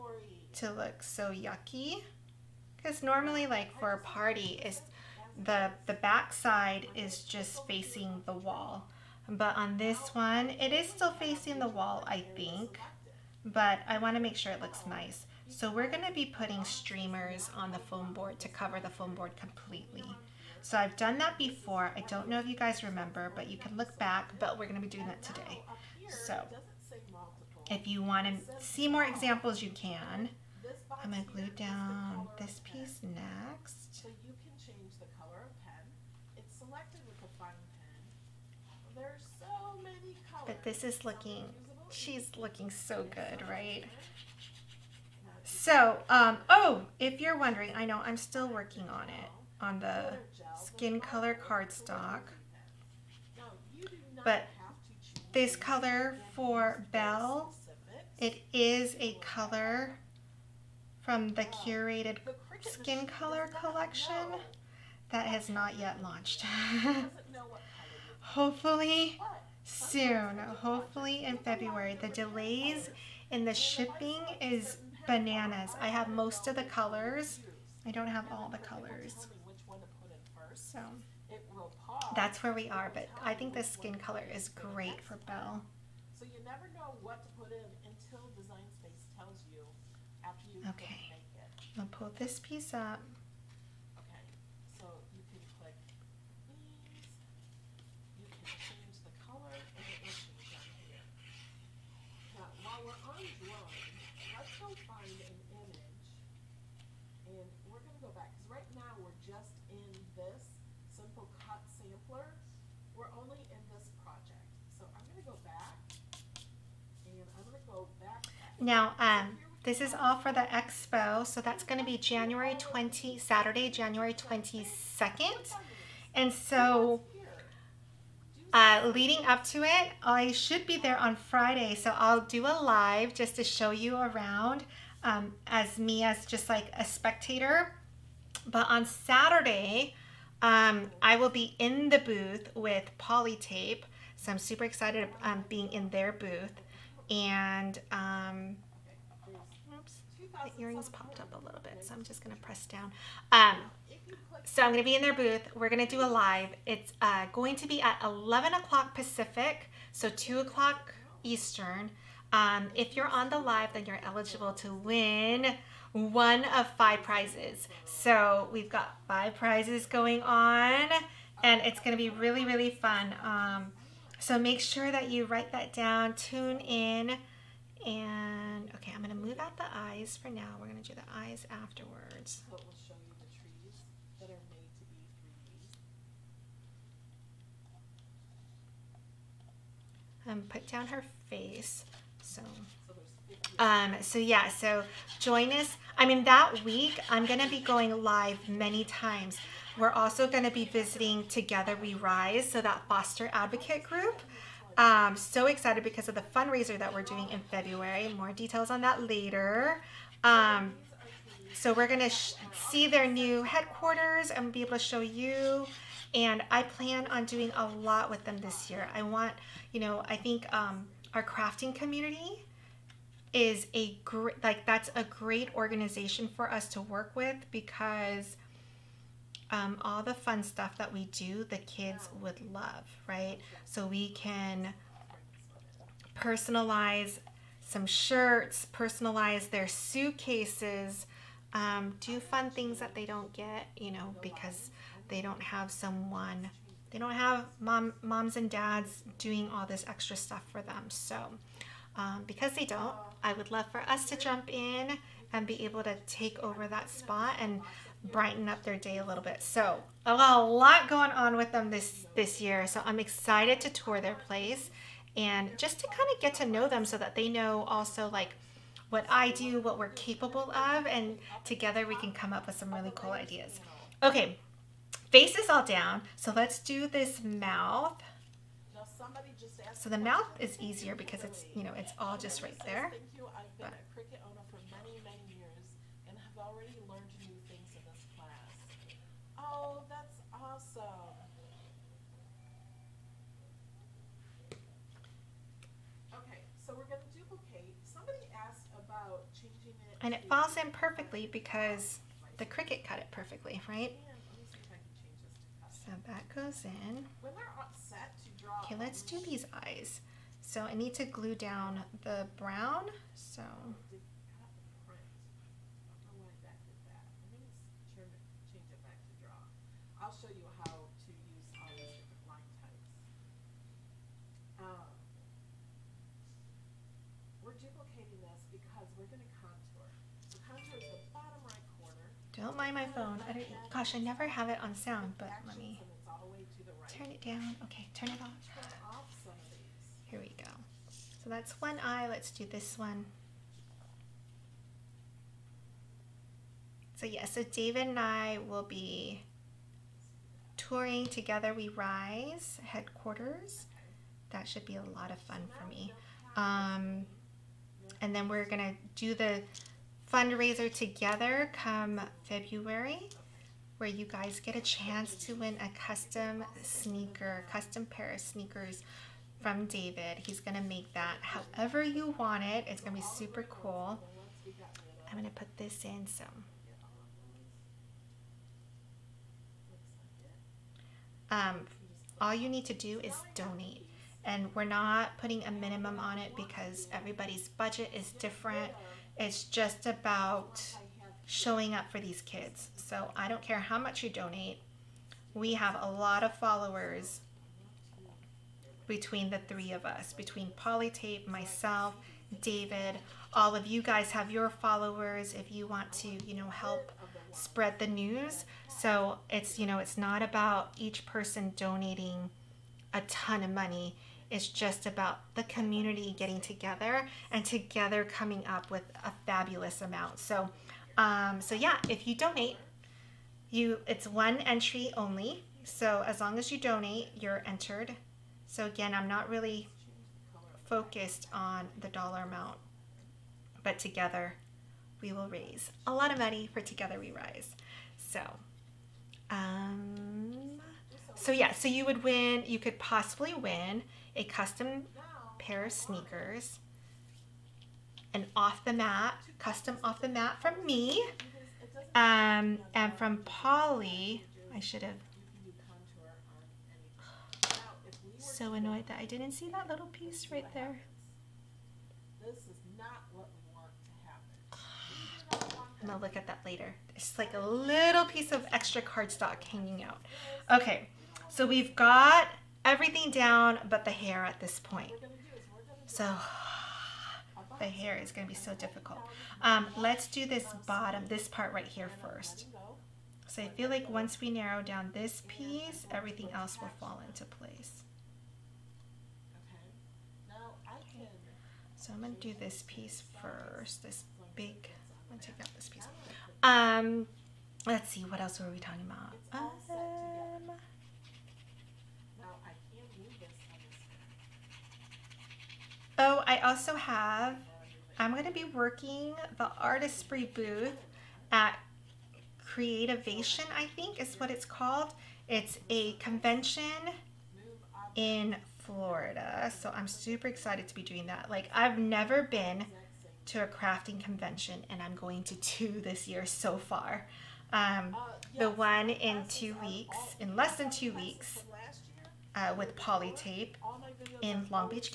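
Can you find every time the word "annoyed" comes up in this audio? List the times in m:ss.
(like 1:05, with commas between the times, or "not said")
7:38.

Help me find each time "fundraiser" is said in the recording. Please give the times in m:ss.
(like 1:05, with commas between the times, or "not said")
3:26, 6:00.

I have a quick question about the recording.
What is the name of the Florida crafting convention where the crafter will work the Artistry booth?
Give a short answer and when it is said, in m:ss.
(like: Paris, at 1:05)
Creativation, at 8:32.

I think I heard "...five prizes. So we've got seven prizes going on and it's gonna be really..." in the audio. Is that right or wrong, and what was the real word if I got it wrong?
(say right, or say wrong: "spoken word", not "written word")
wrong: "five", not "seven".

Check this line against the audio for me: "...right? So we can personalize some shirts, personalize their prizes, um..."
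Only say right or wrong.
wrong.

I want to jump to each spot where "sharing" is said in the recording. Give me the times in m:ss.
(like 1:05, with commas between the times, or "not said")
not said.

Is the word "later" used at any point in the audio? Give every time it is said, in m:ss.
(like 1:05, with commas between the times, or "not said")
3:29, 7:46.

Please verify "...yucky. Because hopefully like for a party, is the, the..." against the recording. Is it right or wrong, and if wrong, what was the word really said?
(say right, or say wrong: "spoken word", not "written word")
wrong: "normally", not "hopefully".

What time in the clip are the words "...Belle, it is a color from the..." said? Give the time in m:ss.
0:56.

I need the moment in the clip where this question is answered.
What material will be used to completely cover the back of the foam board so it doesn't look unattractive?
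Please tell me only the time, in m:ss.
0:16.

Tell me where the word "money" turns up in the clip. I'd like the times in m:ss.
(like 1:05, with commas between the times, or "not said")
6:53, 7:16.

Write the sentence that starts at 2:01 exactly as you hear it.
So that's going to be January 20, Saturday, January 22nd.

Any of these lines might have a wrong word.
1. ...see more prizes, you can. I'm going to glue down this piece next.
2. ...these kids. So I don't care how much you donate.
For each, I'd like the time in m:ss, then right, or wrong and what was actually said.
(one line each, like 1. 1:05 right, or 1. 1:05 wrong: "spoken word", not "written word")
1. 0:28 wrong: "examples", not "prizes"
2. 6:31 right.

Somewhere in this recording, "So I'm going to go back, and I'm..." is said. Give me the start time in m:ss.
1:54.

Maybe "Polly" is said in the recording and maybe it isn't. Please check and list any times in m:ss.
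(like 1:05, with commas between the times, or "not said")
7:33.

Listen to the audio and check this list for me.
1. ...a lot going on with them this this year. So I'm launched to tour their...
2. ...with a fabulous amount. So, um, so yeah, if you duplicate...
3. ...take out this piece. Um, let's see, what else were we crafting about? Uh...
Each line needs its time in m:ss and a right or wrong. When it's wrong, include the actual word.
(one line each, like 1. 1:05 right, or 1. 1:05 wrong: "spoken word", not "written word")
1. 4:20 wrong: "excited", not "launched"
2. 6:58 wrong: "donate", not "duplicate"
3. 8:15 wrong: "talking", not "crafting".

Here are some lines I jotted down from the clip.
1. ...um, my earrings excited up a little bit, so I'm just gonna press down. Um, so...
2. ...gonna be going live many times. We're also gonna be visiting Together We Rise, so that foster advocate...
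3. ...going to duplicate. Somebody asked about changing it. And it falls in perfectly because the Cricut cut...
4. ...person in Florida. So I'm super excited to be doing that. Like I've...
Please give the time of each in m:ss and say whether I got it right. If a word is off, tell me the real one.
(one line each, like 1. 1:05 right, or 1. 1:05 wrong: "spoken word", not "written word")
1. 2:27 wrong: "popped", not "excited"
2. 3:17 right
3. 4:56 right
4. 8:35 wrong: "convention", not "person".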